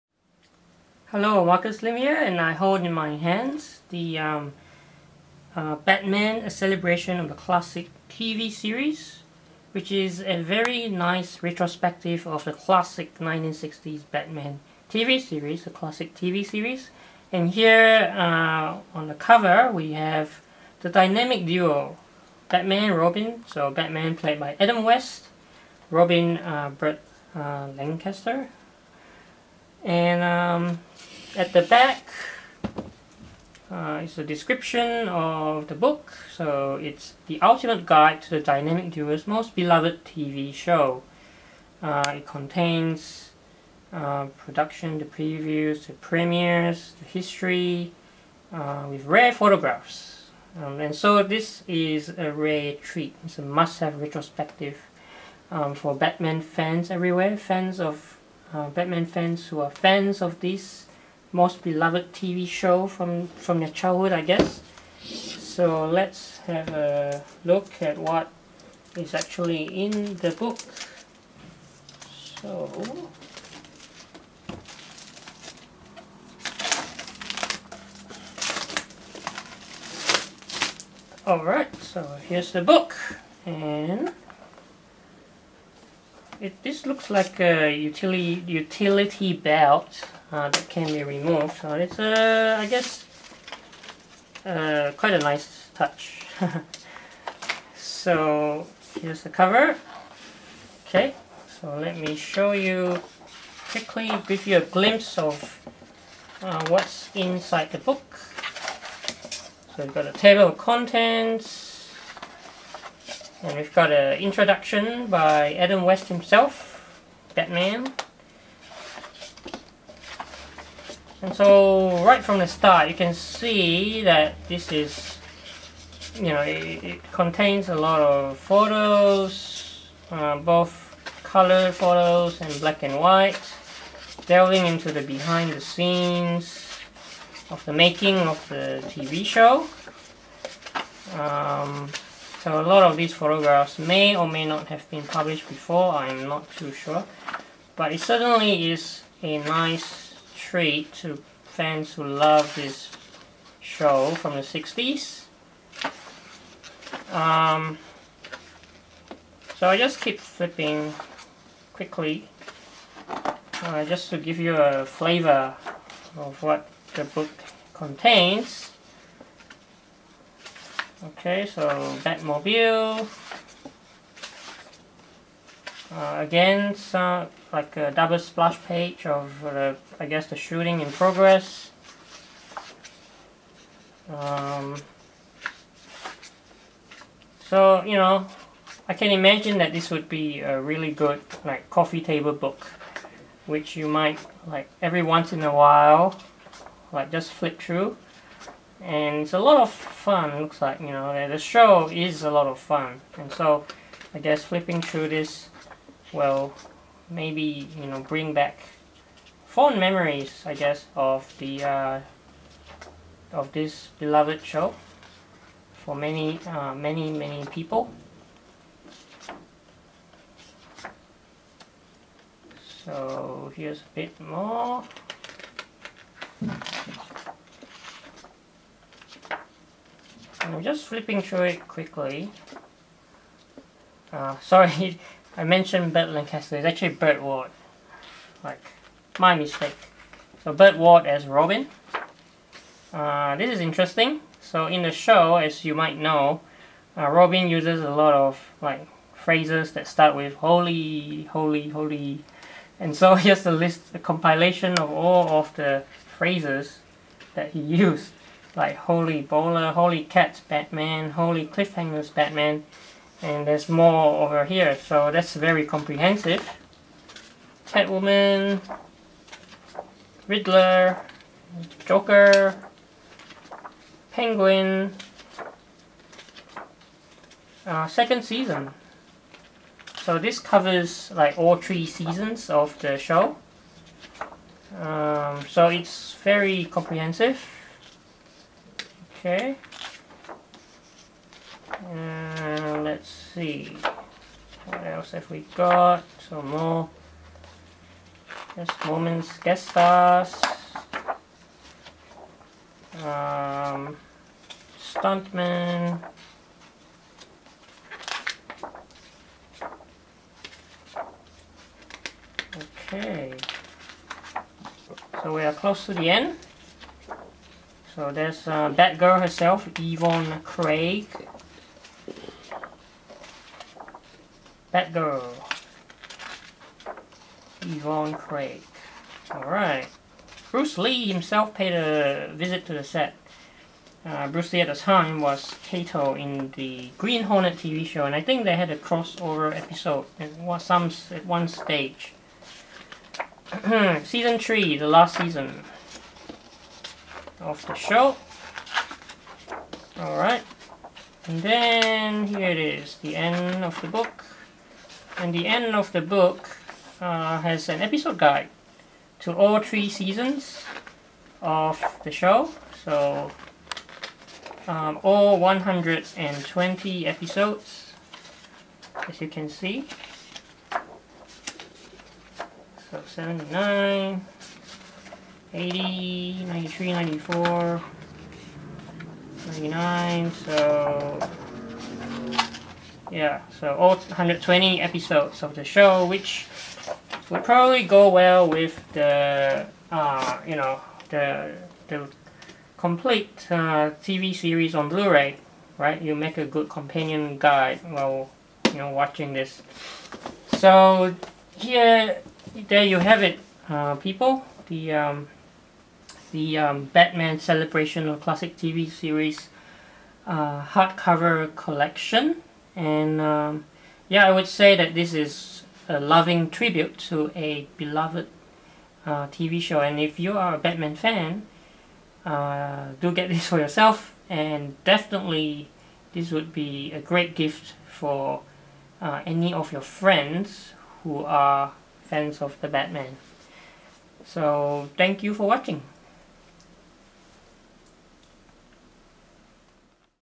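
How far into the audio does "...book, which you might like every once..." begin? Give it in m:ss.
3:12.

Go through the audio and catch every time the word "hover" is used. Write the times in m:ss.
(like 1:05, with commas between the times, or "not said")
not said.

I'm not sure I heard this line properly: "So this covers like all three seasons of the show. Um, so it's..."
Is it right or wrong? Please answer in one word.
right.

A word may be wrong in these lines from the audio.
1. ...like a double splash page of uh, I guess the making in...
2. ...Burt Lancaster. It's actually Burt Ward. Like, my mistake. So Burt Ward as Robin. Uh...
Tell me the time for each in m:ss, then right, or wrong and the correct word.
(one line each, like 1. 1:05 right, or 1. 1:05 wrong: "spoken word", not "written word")
1. 2:57 wrong: "shooting", not "making"
2. 3:55 right.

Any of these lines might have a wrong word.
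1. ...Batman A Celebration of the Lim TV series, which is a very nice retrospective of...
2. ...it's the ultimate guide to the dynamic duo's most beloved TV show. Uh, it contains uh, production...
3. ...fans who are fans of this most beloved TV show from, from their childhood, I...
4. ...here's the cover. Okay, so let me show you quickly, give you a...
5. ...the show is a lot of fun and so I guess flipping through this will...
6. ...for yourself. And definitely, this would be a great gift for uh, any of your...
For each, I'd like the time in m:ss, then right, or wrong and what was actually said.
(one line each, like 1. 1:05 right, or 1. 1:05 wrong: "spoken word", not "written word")
1. 0:05 wrong: "Classic", not "Lim"
2. 0:36 right
3. 0:59 right
4. 1:38 right
5. 3:21 right
6. 7:03 right.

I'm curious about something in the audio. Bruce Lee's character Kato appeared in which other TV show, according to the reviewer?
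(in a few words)
The Green Hornet.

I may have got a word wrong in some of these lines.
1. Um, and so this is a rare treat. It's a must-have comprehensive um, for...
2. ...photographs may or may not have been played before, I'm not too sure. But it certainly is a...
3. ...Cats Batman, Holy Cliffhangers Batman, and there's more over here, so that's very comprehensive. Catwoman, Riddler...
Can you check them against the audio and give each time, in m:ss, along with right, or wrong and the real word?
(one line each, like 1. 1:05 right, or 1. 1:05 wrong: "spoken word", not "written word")
1. 0:50 wrong: "retrospective", not "comprehensive"
2. 2:23 wrong: "published", not "played"
3. 4:20 right.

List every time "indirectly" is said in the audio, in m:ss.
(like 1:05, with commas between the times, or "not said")
not said.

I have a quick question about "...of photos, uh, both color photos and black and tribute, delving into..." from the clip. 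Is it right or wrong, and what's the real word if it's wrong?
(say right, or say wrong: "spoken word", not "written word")
wrong: "white", not "tribute".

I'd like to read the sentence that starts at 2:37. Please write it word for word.
Um, so I just keep flipping quickly uh, just to give you a flavor of what the book contains.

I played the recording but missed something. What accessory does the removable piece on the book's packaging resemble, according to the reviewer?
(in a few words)
Utility belt.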